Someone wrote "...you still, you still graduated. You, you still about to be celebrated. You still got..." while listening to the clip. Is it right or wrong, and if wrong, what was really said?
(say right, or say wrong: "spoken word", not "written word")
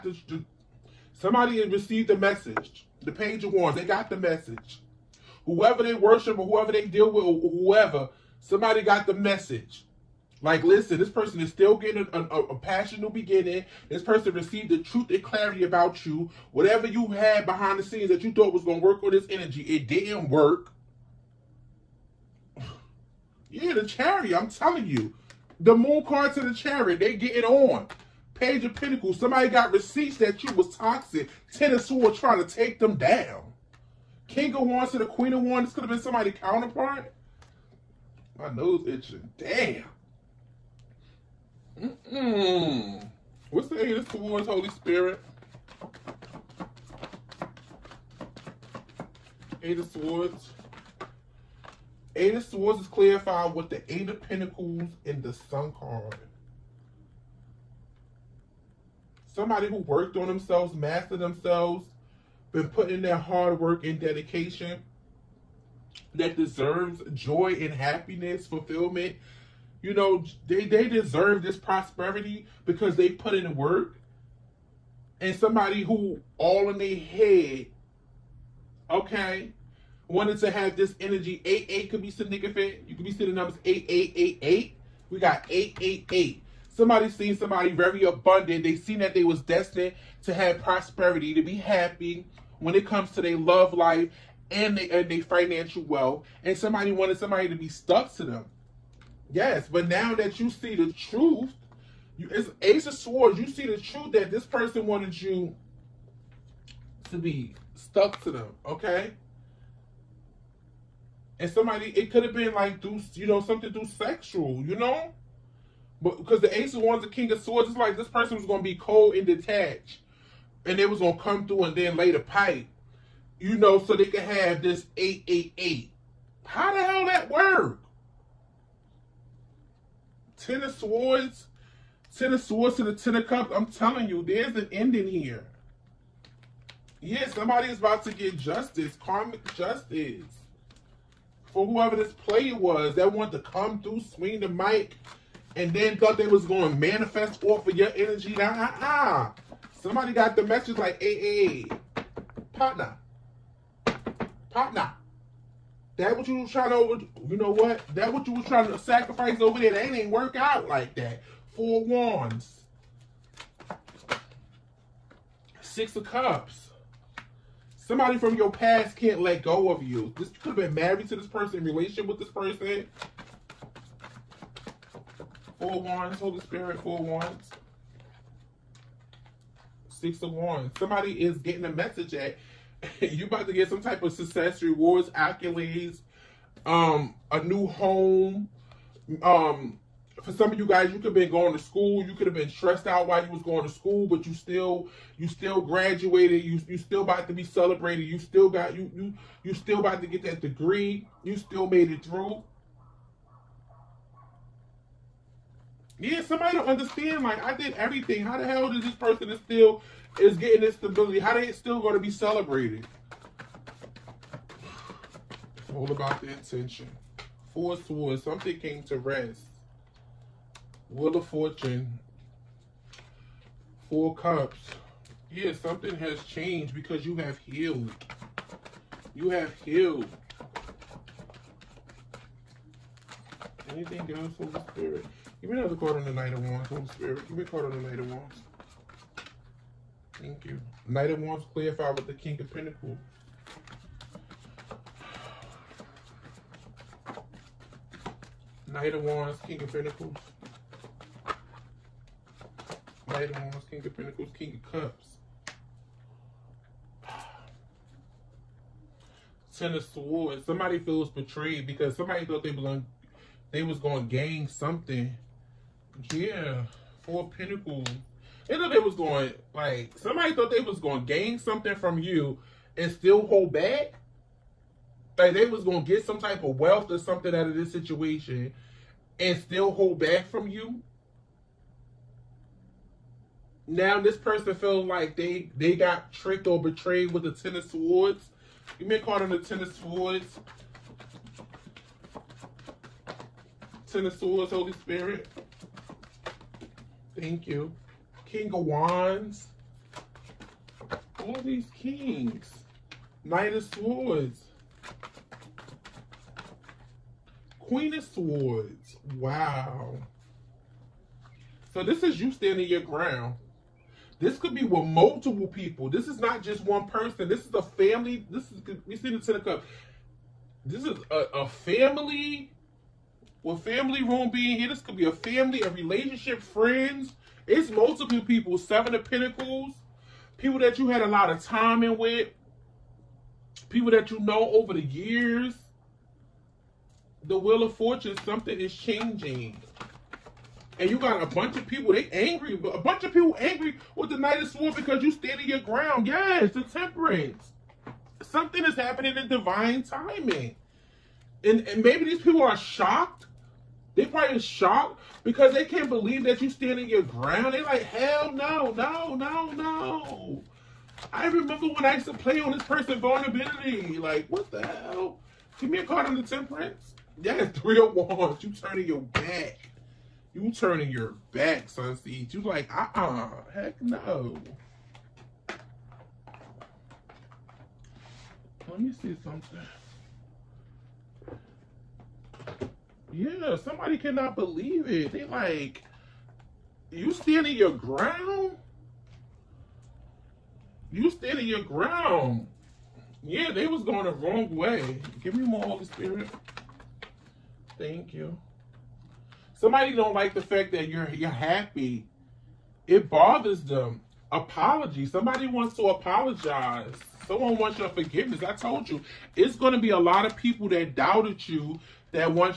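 right.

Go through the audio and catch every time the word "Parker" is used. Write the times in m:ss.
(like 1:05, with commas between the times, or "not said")
not said.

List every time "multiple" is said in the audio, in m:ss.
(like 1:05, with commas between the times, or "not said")
5:14, 5:27.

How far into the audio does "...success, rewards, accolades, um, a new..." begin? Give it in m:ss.
3:04.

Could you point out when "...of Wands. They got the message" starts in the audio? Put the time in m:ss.
0:03.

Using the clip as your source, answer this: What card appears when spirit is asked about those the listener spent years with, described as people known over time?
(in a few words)
Seven of Pentacles.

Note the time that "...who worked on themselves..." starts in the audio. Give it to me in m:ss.
0:59.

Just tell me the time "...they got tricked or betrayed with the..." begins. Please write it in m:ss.
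4:45.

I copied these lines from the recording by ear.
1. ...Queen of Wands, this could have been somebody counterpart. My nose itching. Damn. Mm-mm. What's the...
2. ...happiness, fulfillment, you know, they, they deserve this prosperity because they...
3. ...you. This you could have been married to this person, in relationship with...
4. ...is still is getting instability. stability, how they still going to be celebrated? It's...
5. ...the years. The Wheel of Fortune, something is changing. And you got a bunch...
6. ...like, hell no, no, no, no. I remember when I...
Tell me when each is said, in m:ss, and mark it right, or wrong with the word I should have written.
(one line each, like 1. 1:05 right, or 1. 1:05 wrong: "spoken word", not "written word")
1. 0:35 right
2. 1:07 right
3. 2:49 right
4. 3:29 right
5. 5:34 right
6. 5:57 right.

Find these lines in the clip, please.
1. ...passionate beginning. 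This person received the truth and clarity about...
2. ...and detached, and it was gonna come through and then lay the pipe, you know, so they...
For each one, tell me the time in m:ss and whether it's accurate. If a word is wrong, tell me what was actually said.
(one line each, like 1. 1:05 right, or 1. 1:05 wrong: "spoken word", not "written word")
1. 0:12 right
2. 1:59 right.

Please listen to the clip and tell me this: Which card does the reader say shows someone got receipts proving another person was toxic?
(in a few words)
Page of Pentacles.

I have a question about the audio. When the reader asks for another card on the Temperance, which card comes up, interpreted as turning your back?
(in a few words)
Three of Wands.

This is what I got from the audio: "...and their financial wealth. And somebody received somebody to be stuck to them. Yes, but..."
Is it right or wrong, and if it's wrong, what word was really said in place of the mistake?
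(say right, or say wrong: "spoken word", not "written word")
wrong: "wanted", not "received".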